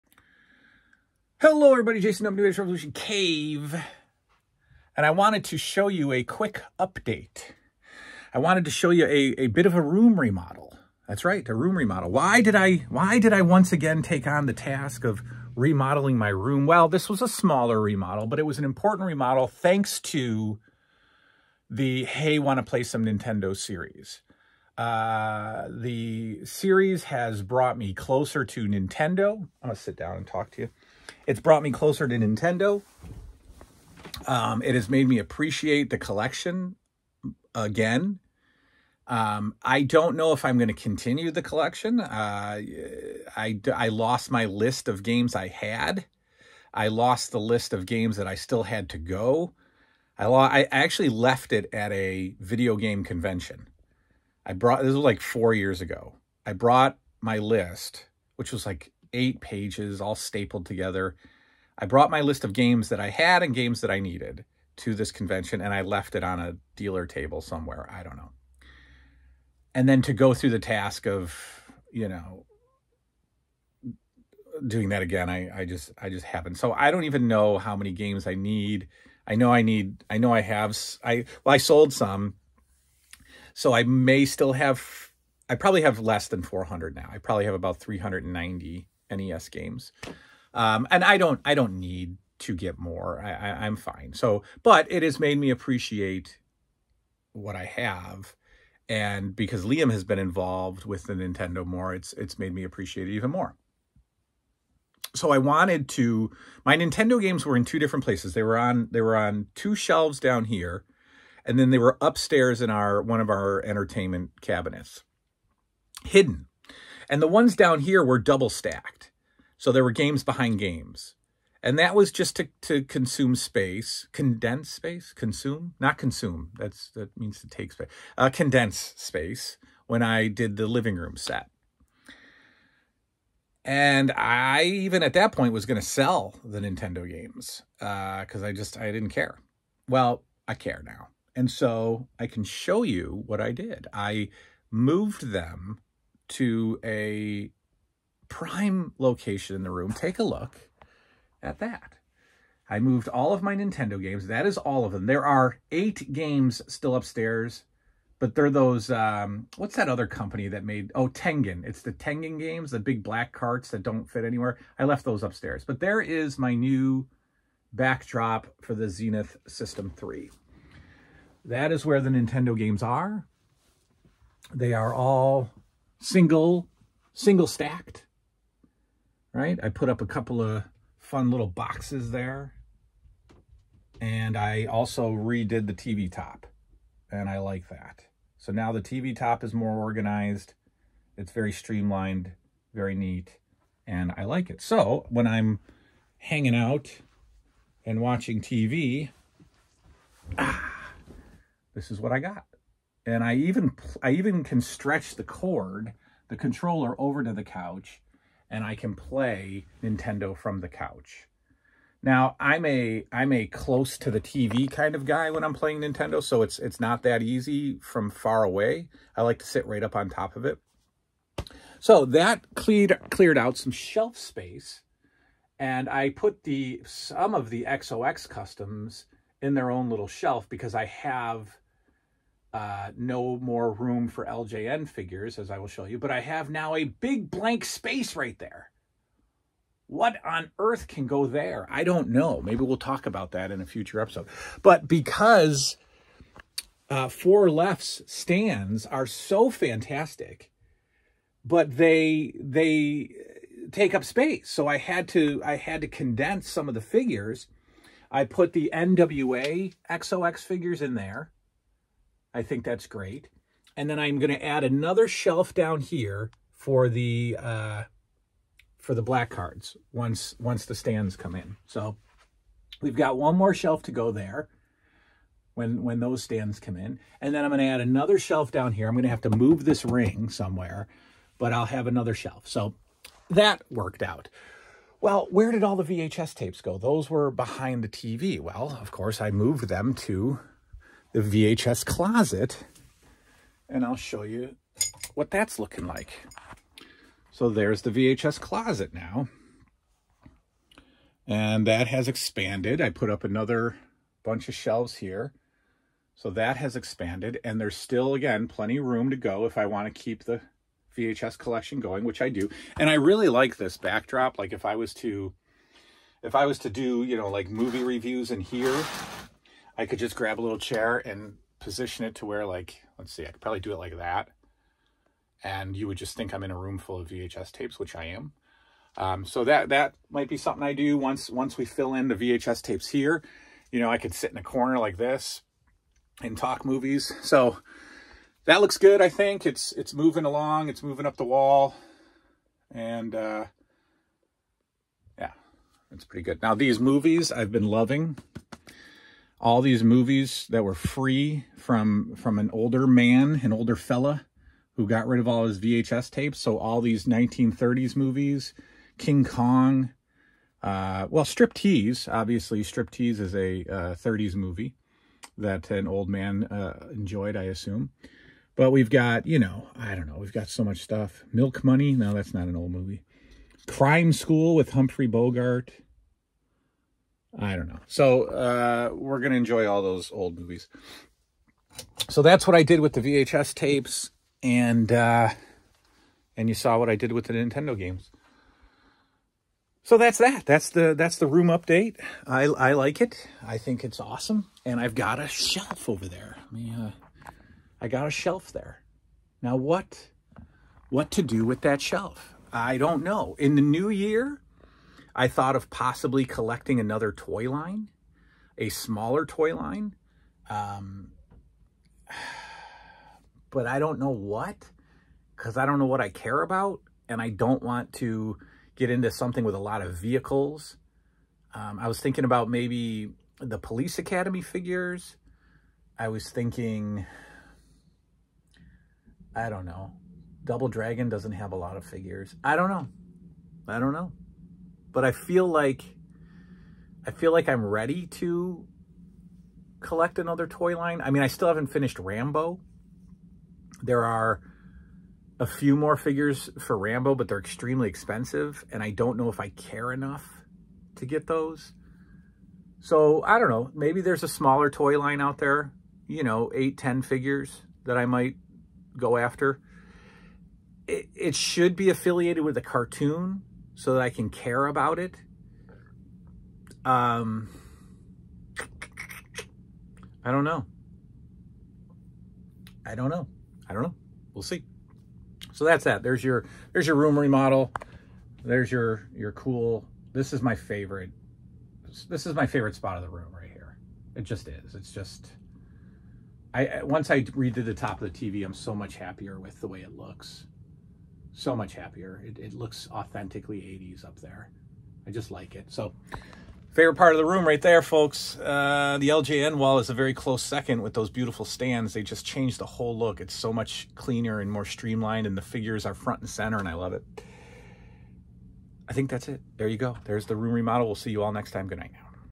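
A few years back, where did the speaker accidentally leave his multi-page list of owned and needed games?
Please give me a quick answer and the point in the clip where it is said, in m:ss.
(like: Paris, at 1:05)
A video game convention, at 0:51.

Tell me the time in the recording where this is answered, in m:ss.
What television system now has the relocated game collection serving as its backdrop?
2:48.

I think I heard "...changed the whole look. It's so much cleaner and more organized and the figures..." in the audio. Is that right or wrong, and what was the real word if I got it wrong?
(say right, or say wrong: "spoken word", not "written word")
wrong: "streamlined", not "organized".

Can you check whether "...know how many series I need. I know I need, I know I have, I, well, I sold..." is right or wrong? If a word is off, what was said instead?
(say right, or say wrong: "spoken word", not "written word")
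wrong: "games", not "series".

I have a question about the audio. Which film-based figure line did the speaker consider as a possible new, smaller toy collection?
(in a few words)
Police Academy.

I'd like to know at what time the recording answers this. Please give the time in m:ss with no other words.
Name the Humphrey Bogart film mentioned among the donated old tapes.
6:13.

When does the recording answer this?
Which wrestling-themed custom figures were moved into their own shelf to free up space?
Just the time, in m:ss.
4:18.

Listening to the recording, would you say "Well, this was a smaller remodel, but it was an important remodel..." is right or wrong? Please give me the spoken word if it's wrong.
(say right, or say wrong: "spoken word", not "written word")
right.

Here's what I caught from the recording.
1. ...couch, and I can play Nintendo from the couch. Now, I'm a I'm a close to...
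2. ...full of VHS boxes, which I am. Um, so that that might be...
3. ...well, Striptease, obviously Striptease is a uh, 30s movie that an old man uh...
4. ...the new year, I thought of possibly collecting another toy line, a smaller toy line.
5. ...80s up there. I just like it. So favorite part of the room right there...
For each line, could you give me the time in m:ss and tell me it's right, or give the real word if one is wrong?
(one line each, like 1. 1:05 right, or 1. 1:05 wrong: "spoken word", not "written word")
1. 3:27 right
2. 5:26 wrong: "tapes", not "boxes"
3. 6:01 right
4. 6:43 right
5. 8:13 right.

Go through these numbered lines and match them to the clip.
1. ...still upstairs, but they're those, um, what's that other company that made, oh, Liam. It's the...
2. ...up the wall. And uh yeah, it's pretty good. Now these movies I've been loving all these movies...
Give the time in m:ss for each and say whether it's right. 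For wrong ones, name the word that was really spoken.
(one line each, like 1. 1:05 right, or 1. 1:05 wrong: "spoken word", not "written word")
1. 2:36 wrong: "Tengen", not "Liam"
2. 5:41 right.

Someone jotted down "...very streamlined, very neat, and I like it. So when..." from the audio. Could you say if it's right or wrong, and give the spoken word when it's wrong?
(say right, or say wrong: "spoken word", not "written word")
right.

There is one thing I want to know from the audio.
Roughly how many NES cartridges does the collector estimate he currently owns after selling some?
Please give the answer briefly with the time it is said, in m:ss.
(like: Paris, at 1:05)
390, at 1:27.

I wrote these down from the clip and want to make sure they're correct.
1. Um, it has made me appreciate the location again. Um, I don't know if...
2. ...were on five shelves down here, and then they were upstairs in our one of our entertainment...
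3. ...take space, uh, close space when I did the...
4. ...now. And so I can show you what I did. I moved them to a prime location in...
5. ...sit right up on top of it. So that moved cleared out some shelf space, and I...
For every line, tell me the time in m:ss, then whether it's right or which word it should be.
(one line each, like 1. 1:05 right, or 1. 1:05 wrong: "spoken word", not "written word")
1. 0:34 wrong: "collection", not "location"
2. 1:49 wrong: "two", not "five"
3. 2:07 wrong: "condense", not "close"
4. 2:20 right
5. 3:39 wrong: "cleared", not "moved".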